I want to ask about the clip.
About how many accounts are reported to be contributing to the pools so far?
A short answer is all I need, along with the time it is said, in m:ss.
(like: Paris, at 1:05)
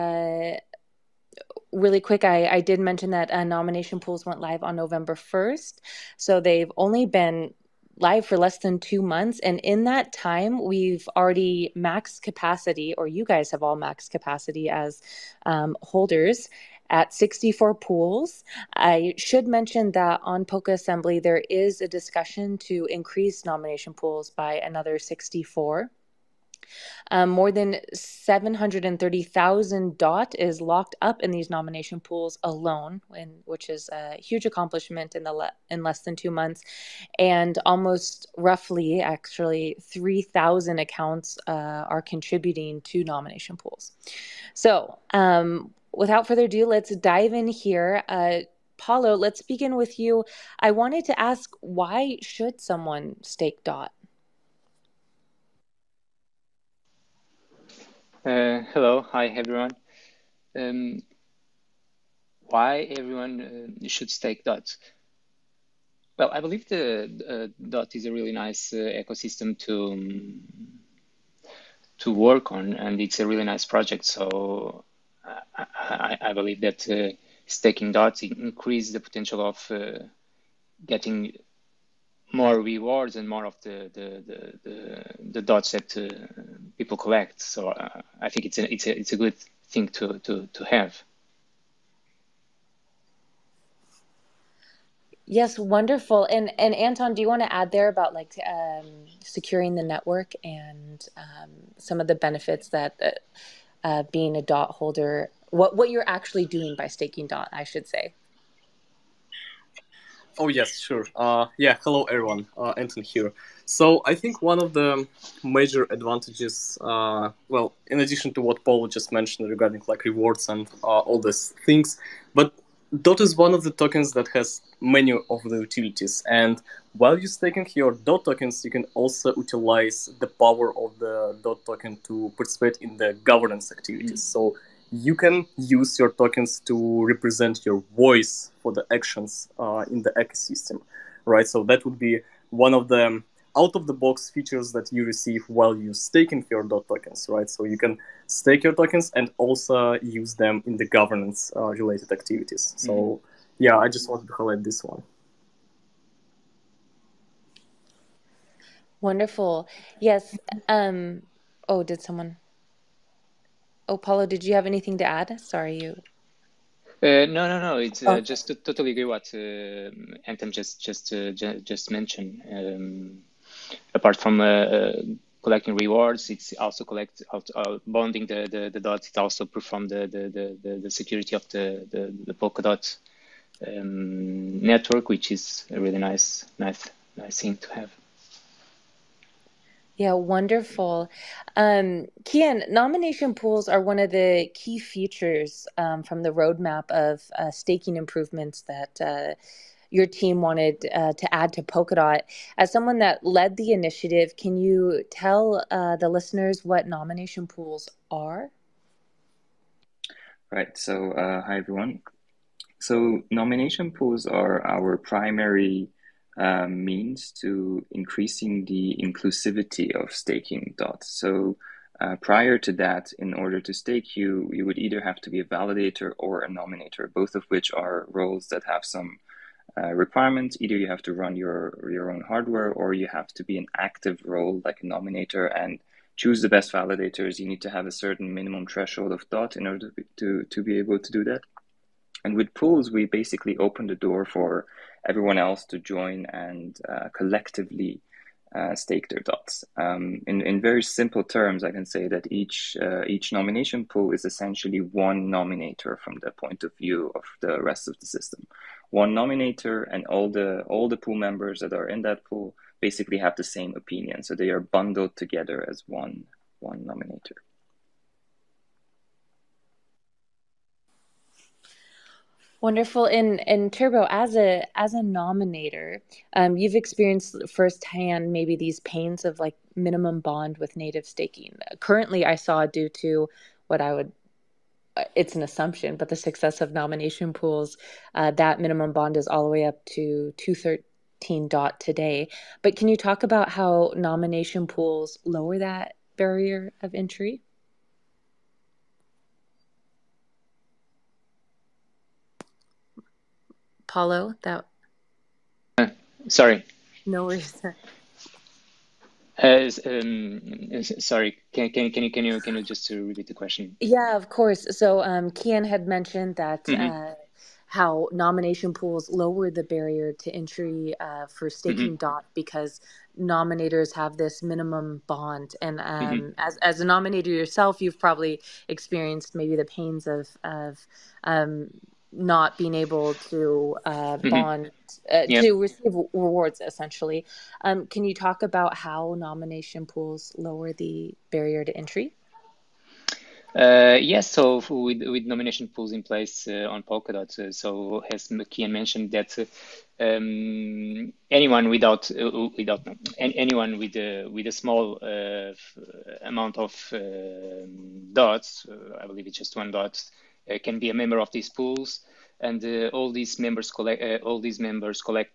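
3,000, at 0:39.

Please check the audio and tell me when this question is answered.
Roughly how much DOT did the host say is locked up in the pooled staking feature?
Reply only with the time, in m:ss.
0:27.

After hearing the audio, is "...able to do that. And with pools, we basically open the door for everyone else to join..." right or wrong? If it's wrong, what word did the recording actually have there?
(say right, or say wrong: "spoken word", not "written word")
right.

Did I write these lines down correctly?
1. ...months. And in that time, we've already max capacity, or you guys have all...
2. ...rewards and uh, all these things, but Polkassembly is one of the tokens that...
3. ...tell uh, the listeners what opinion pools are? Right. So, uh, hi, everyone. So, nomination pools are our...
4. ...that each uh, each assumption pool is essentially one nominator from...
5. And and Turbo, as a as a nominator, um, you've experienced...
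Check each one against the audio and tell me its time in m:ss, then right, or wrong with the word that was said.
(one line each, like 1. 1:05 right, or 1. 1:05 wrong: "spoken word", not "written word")
1. 0:09 right
2. 2:00 wrong: "Dot", not "Polkassembly"
3. 3:25 wrong: "nomination", not "opinion"
4. 4:12 wrong: "nomination", not "assumption"
5. 4:33 right.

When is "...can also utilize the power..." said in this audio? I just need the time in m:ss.
2:08.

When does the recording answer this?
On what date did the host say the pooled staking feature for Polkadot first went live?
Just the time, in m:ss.
0:04.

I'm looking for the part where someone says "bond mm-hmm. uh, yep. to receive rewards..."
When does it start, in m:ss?
5:34.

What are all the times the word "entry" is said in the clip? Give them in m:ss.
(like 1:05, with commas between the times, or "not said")
4:56, 5:20, 5:41.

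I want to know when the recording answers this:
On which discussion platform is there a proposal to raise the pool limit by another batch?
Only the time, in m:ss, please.
0:20.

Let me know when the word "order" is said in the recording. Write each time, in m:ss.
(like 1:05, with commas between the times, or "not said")
3:43, 3:59.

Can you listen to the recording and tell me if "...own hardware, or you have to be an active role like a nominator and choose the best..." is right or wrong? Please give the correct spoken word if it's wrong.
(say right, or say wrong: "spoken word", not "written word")
right.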